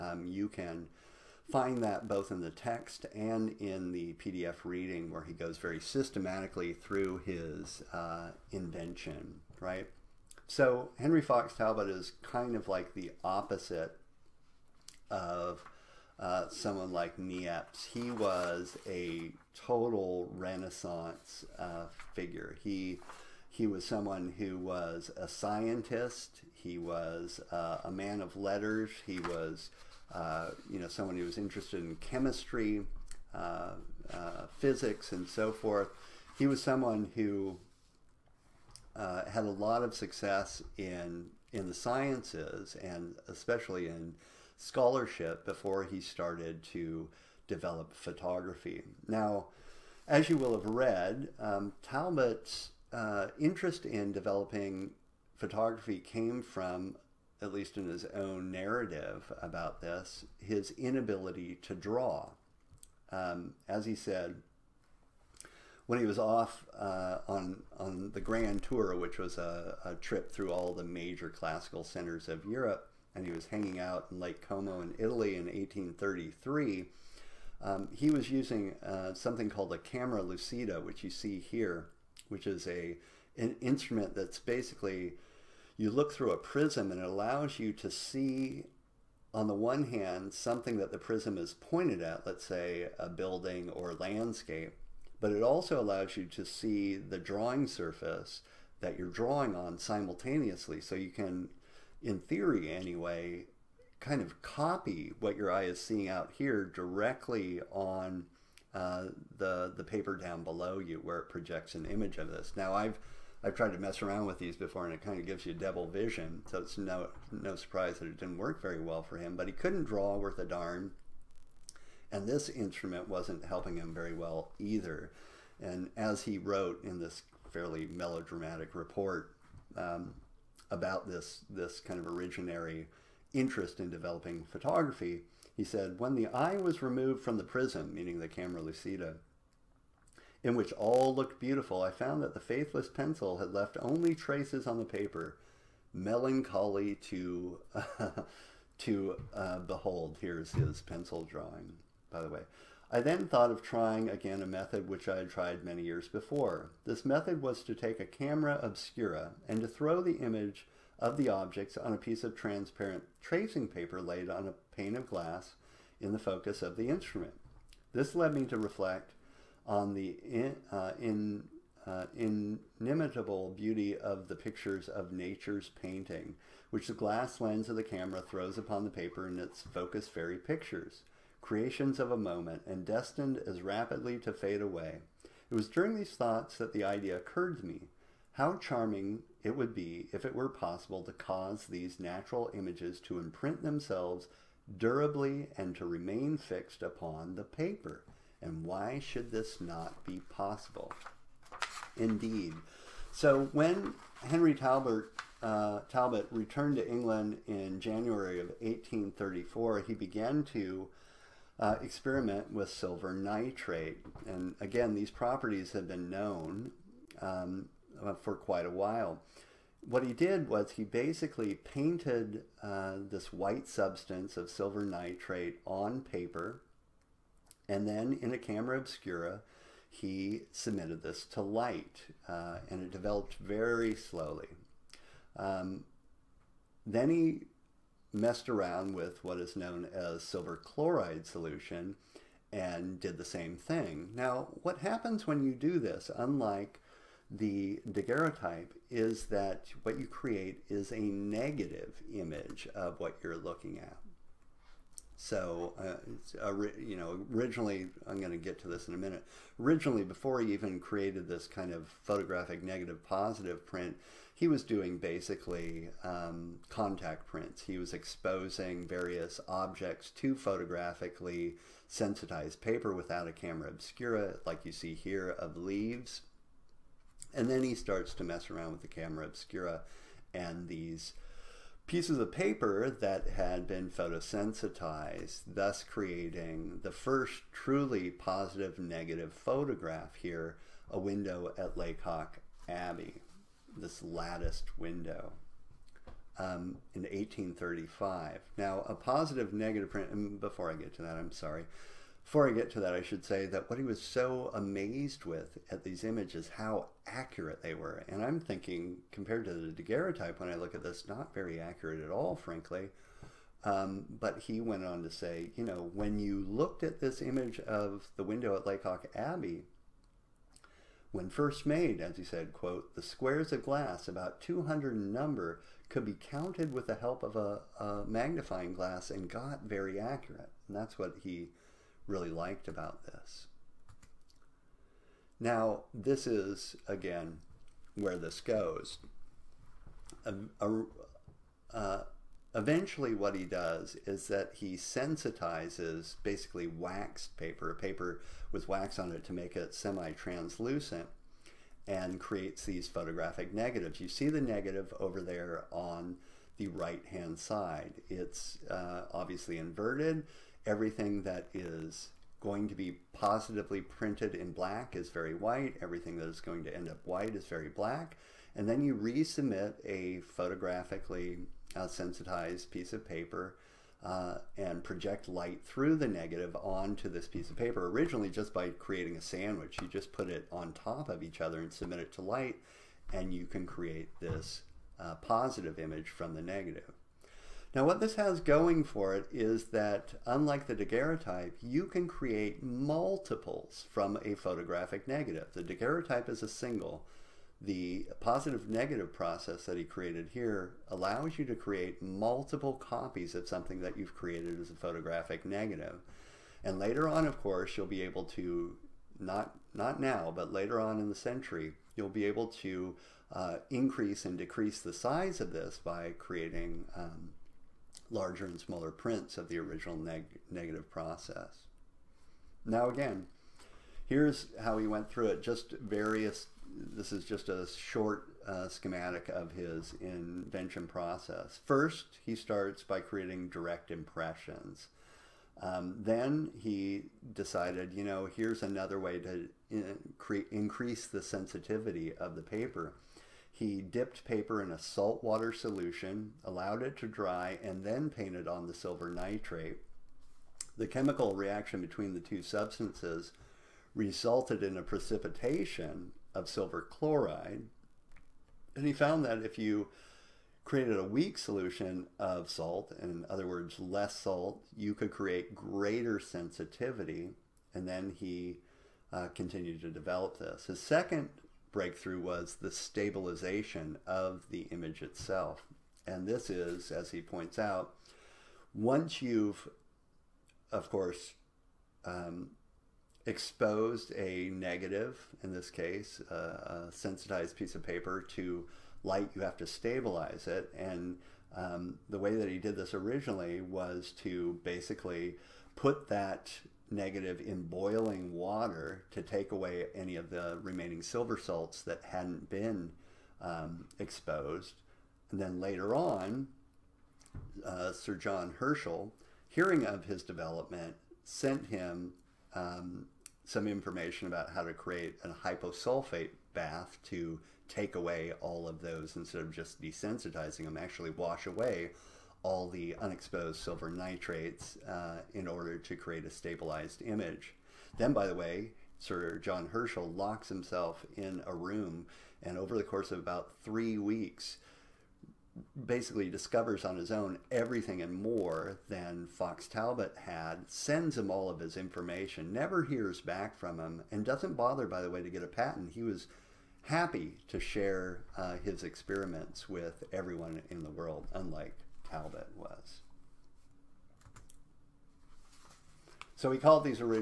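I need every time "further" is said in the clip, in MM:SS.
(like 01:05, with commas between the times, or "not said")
not said.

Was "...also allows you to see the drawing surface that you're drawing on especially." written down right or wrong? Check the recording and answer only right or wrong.
wrong.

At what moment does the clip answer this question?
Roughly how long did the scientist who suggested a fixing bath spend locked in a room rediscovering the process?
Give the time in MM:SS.
08:53.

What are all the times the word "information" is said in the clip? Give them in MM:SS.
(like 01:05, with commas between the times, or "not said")
08:33, 09:01.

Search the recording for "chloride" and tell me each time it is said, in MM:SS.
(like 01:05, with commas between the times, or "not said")
04:00, 07:36.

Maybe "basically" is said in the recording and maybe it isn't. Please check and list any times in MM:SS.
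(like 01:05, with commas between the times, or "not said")
01:24, 03:40, 04:24, 05:46, 08:14, 08:55.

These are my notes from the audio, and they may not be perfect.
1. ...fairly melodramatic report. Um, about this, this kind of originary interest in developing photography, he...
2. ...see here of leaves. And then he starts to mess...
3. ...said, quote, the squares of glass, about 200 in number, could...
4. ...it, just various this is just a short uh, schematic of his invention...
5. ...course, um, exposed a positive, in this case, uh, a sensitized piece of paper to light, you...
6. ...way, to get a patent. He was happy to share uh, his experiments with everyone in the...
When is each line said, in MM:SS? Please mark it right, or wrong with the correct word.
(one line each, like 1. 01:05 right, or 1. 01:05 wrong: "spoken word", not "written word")
1. 02:07 right
2. 04:34 right
3. 05:22 right
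4. 07:05 right
5. 08:00 wrong: "negative", not "positive"
6. 09:05 right.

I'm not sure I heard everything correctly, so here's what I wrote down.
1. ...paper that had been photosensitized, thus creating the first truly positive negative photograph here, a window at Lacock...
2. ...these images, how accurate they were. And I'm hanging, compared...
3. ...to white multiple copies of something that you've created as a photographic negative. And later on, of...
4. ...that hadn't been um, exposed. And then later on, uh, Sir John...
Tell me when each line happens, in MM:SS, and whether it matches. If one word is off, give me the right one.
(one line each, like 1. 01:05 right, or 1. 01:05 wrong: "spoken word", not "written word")
1. 04:42 right
2. 05:05 wrong: "thinking", not "hanging"
3. 06:41 wrong: "create", not "white"
4. 08:21 right.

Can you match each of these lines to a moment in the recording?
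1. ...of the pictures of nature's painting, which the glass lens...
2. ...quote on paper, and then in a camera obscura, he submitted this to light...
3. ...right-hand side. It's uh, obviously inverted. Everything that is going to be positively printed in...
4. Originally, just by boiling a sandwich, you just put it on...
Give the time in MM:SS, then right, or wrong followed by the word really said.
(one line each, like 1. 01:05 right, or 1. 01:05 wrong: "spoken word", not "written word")
1. 02:53 right
2. 03:44 wrong: "nitrate", not "quote"
3. 05:56 right
4. 06:17 wrong: "creating", not "boiling".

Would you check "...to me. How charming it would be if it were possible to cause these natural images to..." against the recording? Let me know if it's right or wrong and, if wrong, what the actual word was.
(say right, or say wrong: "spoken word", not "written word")
right.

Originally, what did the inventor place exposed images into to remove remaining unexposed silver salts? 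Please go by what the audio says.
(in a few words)
boiling water.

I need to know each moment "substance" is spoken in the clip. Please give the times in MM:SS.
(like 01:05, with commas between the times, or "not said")
03:43, 07:32.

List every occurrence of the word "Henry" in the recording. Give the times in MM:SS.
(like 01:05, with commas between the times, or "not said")
00:10, 03:24.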